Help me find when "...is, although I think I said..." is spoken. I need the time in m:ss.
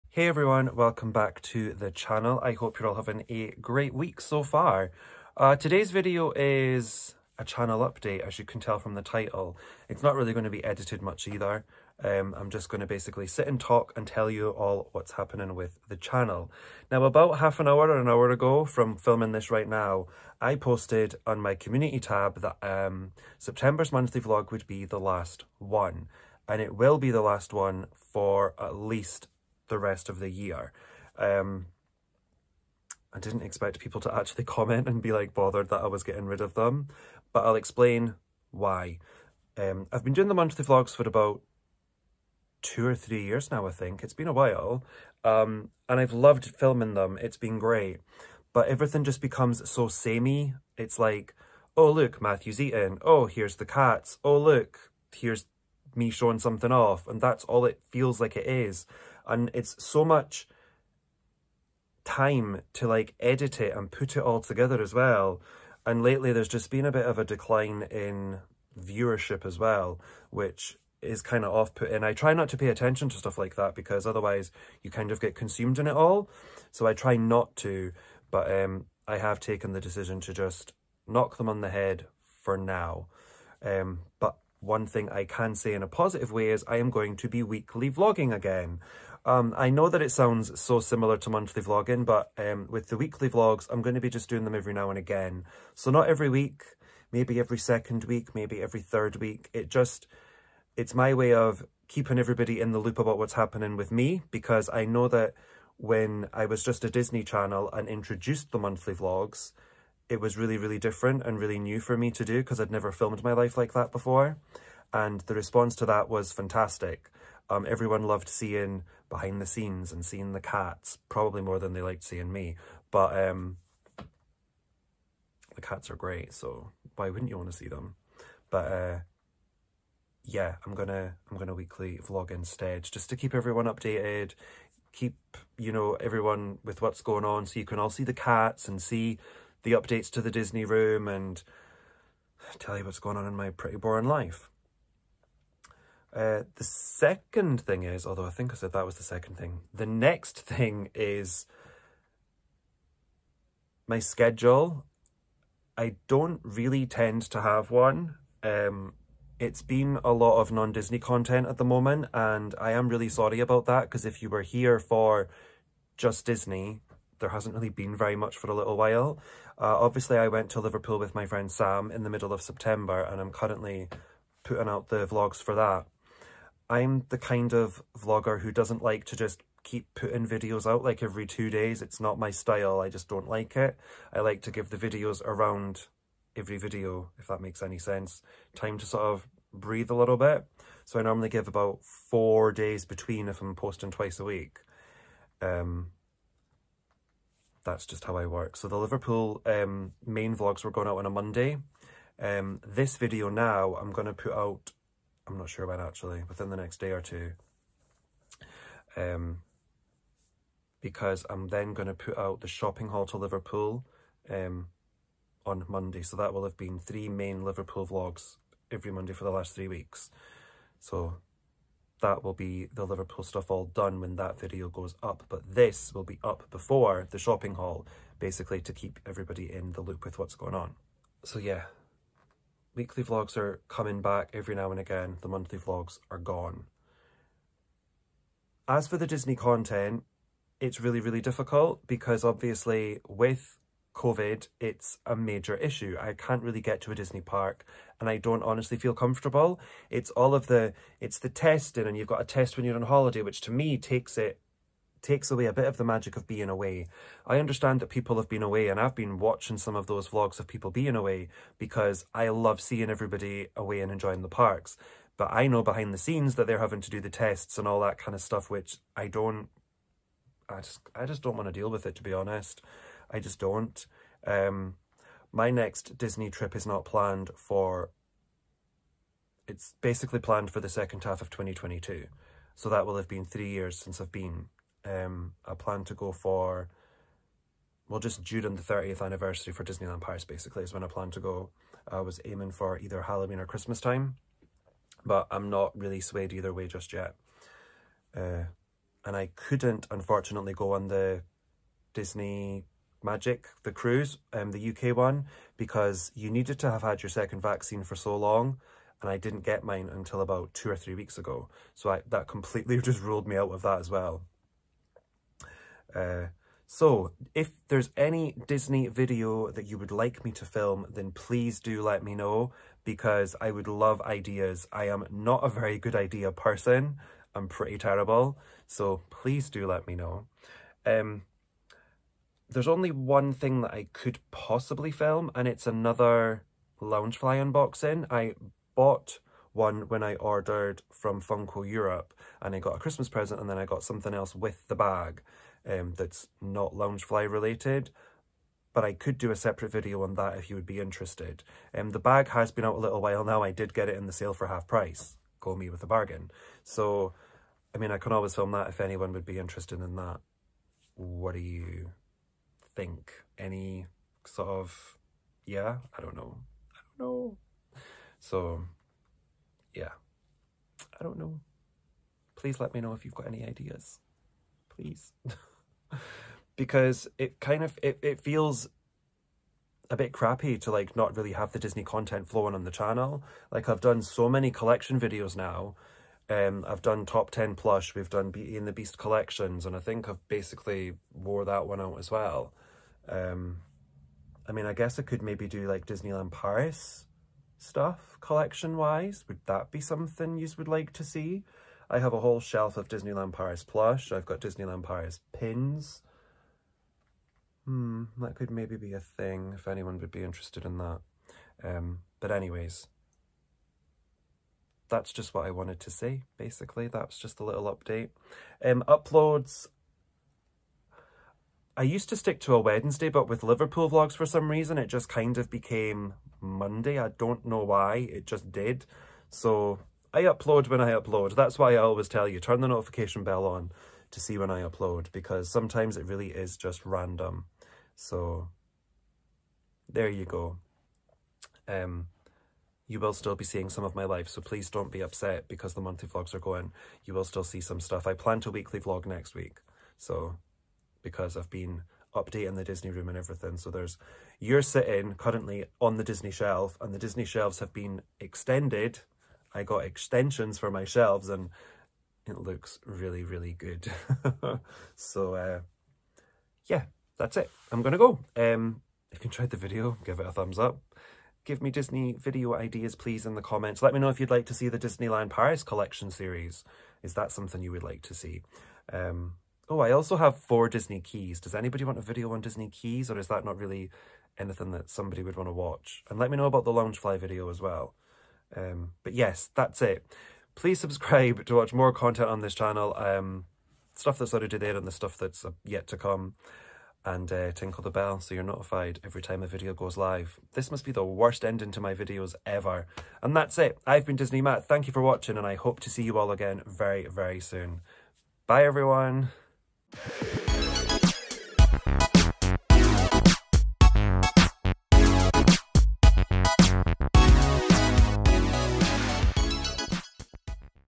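2:27.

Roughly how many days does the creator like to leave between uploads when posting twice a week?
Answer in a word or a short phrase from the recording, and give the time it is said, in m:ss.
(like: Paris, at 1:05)
4, at 3:11.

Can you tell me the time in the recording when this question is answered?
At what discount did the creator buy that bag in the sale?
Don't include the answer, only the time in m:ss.
5:54.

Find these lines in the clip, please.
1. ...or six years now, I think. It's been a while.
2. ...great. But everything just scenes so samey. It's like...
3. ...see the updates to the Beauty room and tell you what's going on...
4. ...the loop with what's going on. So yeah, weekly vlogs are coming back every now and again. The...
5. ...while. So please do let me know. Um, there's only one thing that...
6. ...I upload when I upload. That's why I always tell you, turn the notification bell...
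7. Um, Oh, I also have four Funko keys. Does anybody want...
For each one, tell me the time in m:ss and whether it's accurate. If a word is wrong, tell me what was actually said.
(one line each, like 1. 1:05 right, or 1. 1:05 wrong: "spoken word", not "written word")
1. 0:42 wrong: "three", not "six"
2. 0:47 wrong: "becomes", not "scenes"
3. 2:18 wrong: "Disney", not "Beauty"
4. 3:49 right
5. 5:27 wrong: "terrible", not "while"
6. 7:10 right
7. 7:58 wrong: "Disney", not "Funko".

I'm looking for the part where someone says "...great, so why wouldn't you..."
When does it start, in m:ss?
2:05.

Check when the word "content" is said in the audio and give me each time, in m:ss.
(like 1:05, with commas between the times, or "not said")
2:40, 3:59, 6:21, 8:11.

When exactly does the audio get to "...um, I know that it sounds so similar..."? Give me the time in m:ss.
1:29.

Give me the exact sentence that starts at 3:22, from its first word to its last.
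Um, this video now, I'm going to put out I'm not sure about actually, within the next day or two.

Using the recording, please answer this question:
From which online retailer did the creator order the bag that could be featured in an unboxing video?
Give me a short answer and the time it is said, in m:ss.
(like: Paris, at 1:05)
Funko Europe, at 5:41.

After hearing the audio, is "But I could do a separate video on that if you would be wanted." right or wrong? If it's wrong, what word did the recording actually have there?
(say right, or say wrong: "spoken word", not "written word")
wrong: "interested", not "wanted".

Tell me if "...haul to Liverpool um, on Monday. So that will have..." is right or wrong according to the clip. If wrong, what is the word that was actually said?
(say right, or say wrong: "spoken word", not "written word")
right.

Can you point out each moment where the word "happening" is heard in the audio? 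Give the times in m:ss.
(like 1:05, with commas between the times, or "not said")
0:15, 1:43.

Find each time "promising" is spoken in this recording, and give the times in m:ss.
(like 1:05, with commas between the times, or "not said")
not said.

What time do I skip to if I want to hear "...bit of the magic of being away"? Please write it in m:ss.
4:15.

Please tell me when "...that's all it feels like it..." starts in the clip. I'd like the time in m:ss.
0:57.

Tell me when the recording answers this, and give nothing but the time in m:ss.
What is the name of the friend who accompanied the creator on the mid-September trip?
2:51.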